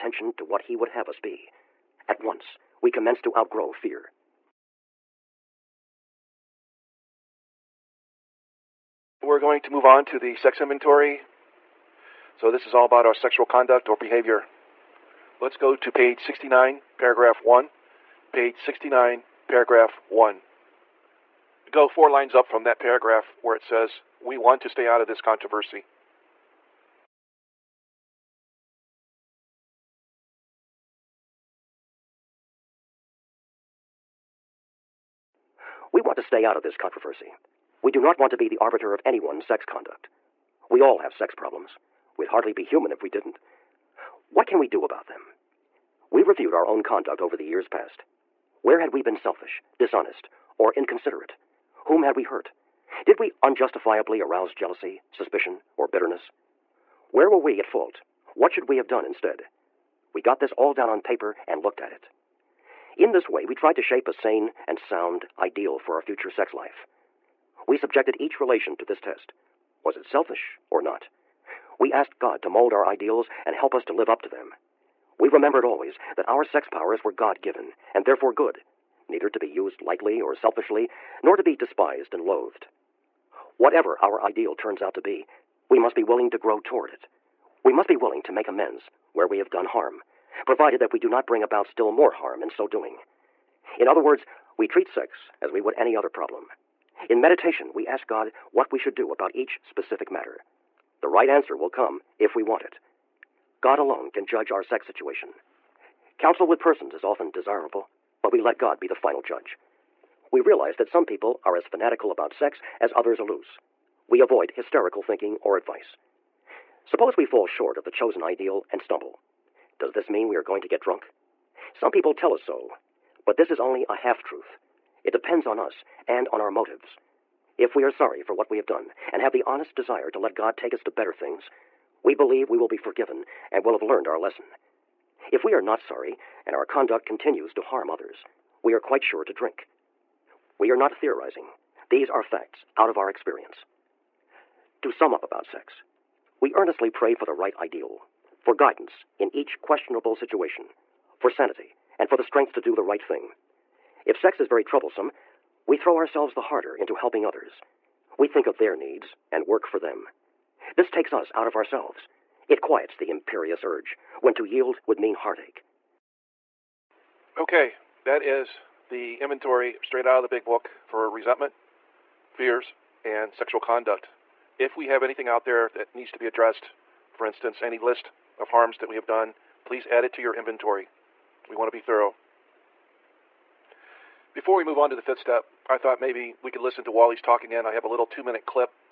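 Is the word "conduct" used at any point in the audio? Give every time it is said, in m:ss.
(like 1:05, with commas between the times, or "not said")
0:13, 0:39, 0:46, 2:16, 2:53.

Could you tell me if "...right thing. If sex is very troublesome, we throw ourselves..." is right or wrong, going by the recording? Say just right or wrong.
right.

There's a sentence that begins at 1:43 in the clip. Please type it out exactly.
God alone can judge our sex situation.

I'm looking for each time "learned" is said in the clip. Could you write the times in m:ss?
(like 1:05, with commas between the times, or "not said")
2:13.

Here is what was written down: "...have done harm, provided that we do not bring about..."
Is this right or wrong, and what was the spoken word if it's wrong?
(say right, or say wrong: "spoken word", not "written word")
right.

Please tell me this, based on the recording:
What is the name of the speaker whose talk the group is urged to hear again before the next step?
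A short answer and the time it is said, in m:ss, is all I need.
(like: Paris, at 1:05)
Wally, at 3:06.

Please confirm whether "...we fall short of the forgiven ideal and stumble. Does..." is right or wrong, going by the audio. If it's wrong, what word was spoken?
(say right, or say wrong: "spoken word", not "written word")
wrong: "chosen", not "forgiven".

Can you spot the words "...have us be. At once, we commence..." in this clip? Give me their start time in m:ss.
0:00.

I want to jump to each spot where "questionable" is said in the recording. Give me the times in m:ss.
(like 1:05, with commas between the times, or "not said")
2:29.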